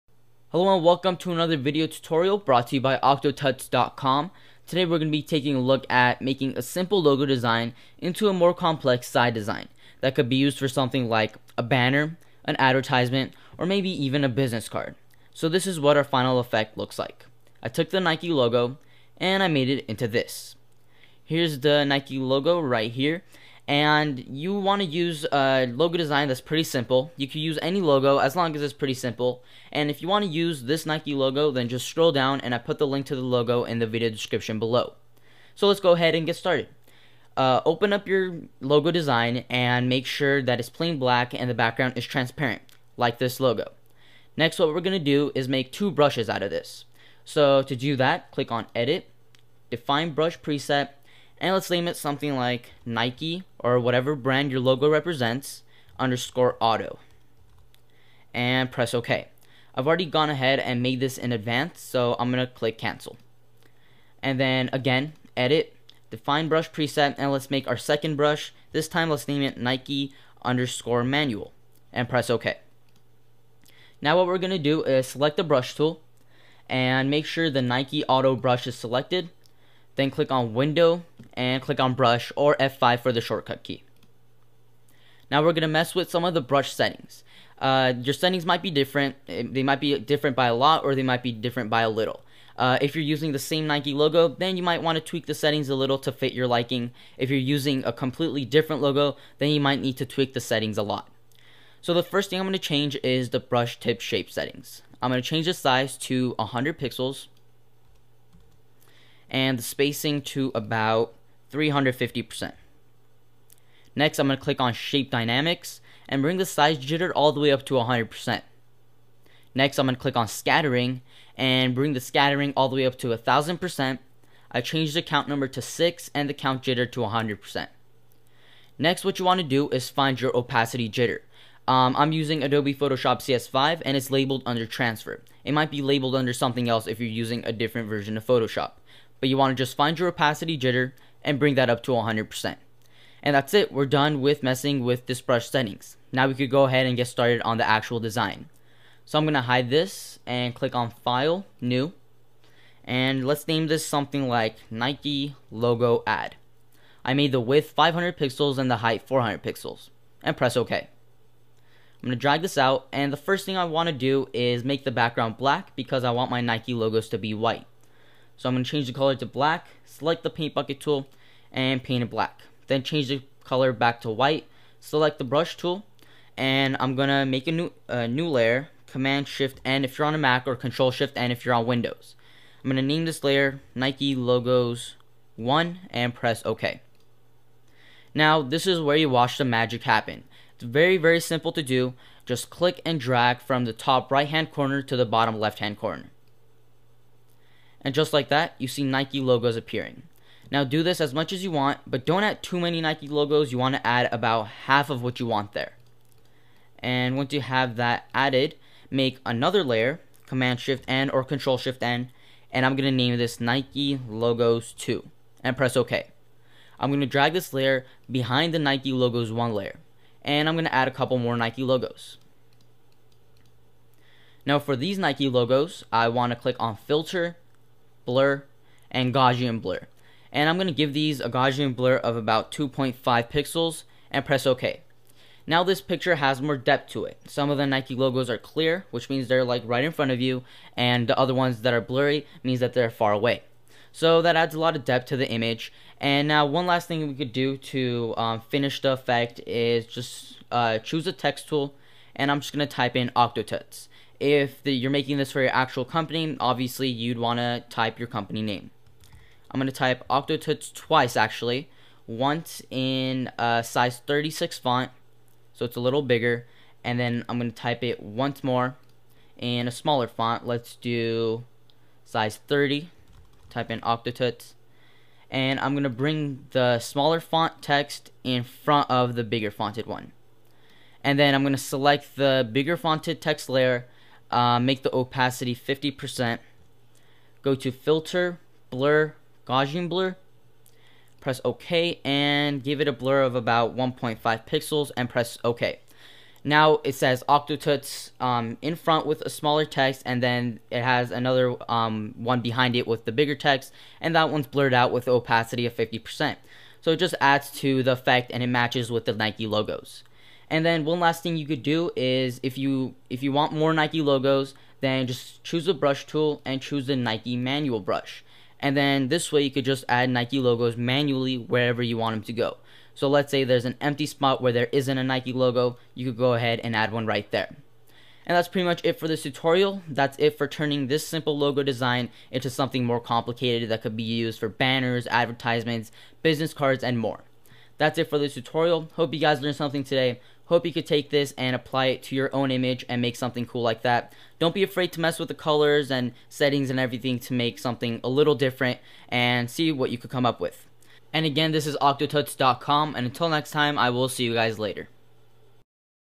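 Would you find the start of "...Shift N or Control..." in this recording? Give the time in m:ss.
3:30.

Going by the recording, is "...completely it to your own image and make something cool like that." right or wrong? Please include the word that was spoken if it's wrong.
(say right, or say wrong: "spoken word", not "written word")
wrong: "apply", not "completely".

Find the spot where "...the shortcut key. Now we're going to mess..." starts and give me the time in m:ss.
1:23.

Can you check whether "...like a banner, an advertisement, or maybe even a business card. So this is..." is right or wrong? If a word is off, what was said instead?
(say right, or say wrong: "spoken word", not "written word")
right.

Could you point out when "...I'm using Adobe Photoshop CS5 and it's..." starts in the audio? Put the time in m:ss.
2:11.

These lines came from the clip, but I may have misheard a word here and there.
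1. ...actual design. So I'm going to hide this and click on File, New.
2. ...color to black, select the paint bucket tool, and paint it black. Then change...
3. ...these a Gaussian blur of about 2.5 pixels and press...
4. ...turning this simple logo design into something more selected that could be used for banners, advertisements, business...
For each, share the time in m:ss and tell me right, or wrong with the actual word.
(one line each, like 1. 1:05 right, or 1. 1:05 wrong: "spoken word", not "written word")
1. 2:27 right
2. 2:48 right
3. 3:50 right
4. 5:30 wrong: "complicated", not "selected".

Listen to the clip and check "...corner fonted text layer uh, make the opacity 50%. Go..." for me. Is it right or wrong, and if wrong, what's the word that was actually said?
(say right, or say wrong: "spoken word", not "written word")
wrong: "bigger", not "corner".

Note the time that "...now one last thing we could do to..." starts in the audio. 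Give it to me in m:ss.
4:06.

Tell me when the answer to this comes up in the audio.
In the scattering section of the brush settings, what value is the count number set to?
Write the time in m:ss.
2:05.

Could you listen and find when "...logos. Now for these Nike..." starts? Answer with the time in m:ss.
3:41.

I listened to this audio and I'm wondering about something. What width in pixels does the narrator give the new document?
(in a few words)
500 pixels.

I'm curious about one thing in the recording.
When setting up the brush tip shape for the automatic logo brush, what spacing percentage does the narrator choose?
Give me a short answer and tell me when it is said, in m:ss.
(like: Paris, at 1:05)
350%, at 1:51.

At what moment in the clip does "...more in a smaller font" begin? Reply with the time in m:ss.
4:28.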